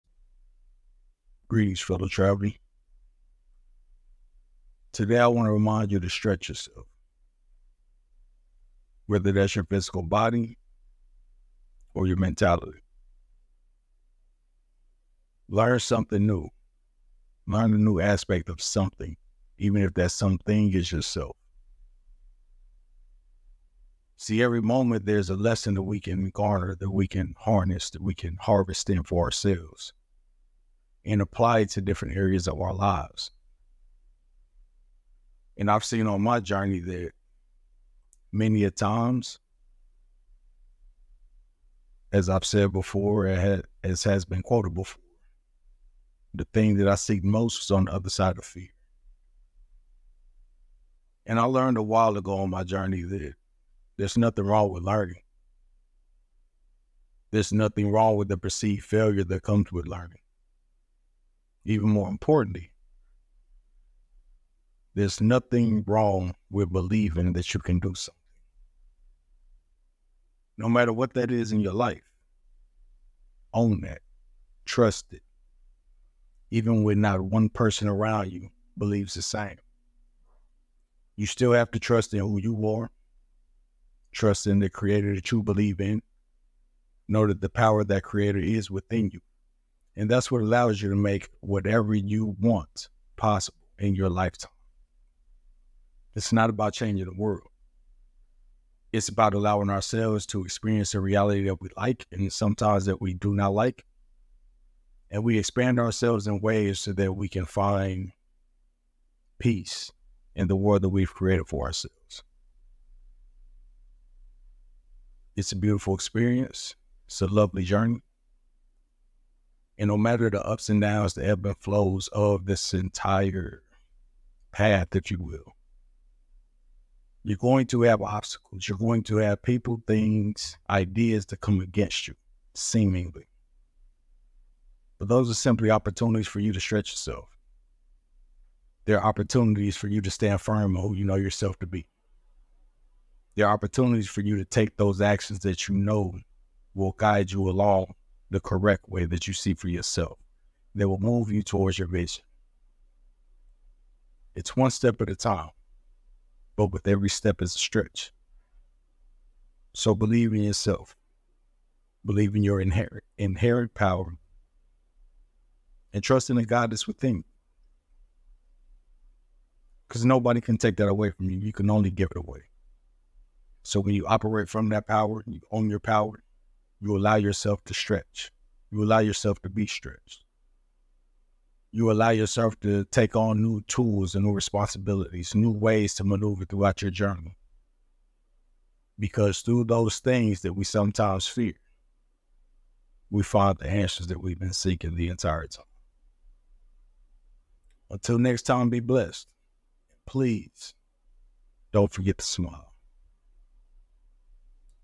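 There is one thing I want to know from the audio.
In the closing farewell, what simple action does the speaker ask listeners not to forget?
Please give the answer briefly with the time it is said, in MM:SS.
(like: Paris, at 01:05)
smile, at 03:22.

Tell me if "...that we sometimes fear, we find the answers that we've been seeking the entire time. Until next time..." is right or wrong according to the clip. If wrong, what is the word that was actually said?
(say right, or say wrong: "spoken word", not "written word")
right.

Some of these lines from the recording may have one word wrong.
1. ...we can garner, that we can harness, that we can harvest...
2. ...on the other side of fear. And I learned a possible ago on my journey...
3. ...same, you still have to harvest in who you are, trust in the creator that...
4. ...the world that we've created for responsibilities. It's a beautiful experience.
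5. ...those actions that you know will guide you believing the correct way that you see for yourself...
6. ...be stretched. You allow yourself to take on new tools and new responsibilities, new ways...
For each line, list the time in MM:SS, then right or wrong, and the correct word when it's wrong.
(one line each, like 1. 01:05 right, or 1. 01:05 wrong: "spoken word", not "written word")
1. 00:25 right
2. 00:47 wrong: "while", not "possible"
3. 01:19 wrong: "trust", not "harvest"
4. 01:50 wrong: "ourselves", not "responsibilities"
5. 02:24 wrong: "along", not "believing"
6. 02:59 right.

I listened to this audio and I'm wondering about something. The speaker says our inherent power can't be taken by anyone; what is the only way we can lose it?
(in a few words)
give it away.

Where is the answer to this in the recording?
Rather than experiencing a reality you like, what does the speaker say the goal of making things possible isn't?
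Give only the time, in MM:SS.
01:36.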